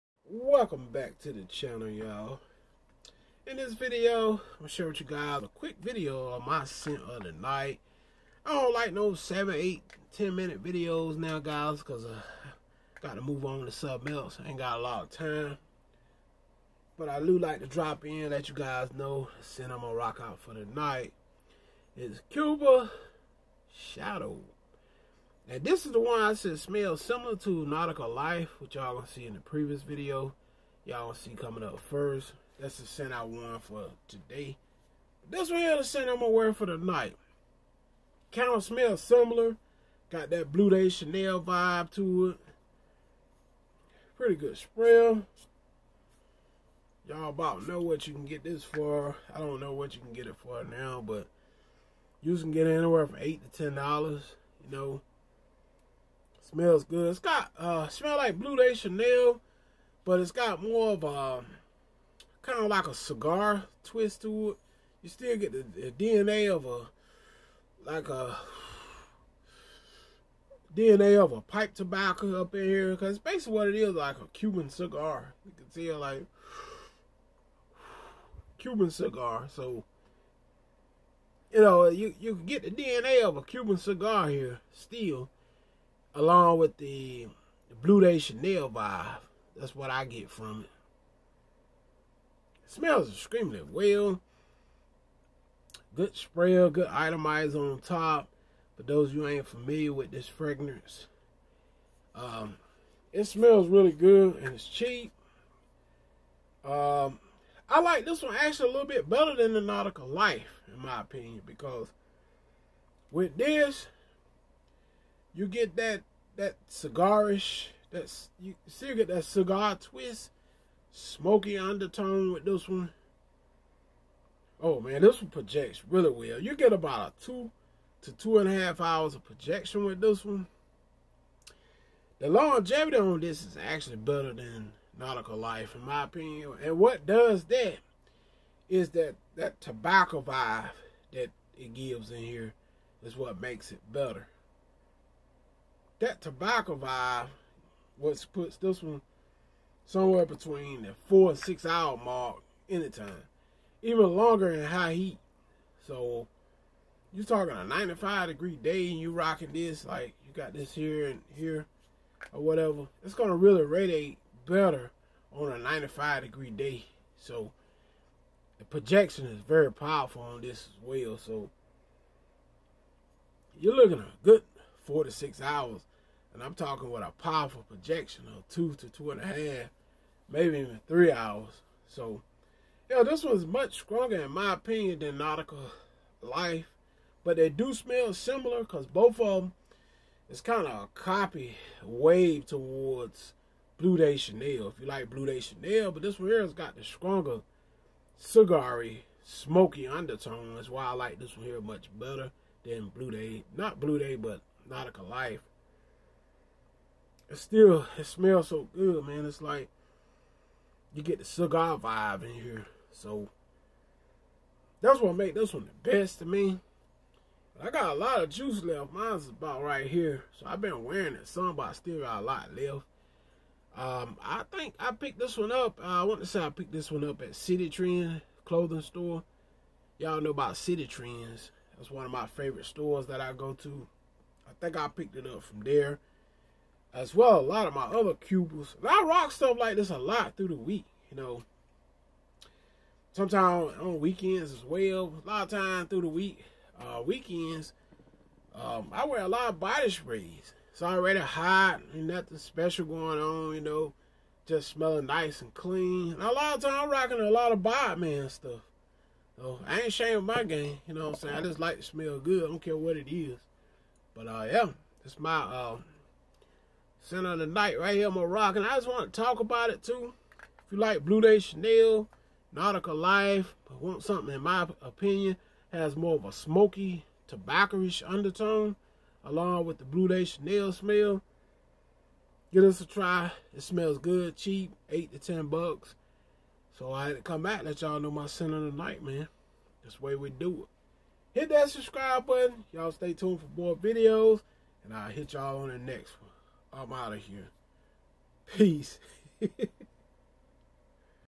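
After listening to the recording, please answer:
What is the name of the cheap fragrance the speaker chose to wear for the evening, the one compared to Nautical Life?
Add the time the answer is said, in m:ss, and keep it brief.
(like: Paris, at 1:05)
Cuba Shadow, at 0:22.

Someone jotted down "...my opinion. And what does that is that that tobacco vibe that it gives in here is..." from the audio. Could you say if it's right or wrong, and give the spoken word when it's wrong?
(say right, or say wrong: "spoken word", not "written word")
right.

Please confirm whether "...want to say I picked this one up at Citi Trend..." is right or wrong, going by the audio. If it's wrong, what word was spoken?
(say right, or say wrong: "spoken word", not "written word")
right.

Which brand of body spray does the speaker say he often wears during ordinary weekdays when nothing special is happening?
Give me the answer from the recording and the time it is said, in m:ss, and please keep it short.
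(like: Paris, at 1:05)
Bod Man, at 4:17.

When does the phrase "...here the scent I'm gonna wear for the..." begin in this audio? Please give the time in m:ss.
0:35.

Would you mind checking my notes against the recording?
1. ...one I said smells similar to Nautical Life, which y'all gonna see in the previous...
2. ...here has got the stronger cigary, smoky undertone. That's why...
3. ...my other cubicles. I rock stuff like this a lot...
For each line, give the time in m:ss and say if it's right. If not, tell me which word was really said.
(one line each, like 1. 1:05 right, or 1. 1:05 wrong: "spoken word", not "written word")
1. 0:25 right
2. 3:16 right
3. 3:57 right.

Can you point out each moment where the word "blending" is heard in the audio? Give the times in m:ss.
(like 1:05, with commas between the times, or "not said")
not said.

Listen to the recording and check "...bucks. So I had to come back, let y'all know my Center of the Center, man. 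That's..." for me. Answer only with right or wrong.
wrong.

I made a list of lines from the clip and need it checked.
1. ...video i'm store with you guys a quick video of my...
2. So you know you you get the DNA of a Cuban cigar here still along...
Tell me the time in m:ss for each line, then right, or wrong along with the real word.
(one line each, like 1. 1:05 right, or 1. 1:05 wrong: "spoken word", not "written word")
1. 0:03 wrong: "share", not "store"
2. 1:19 right.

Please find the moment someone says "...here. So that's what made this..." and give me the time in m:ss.
3:32.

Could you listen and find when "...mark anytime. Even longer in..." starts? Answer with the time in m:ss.
2:32.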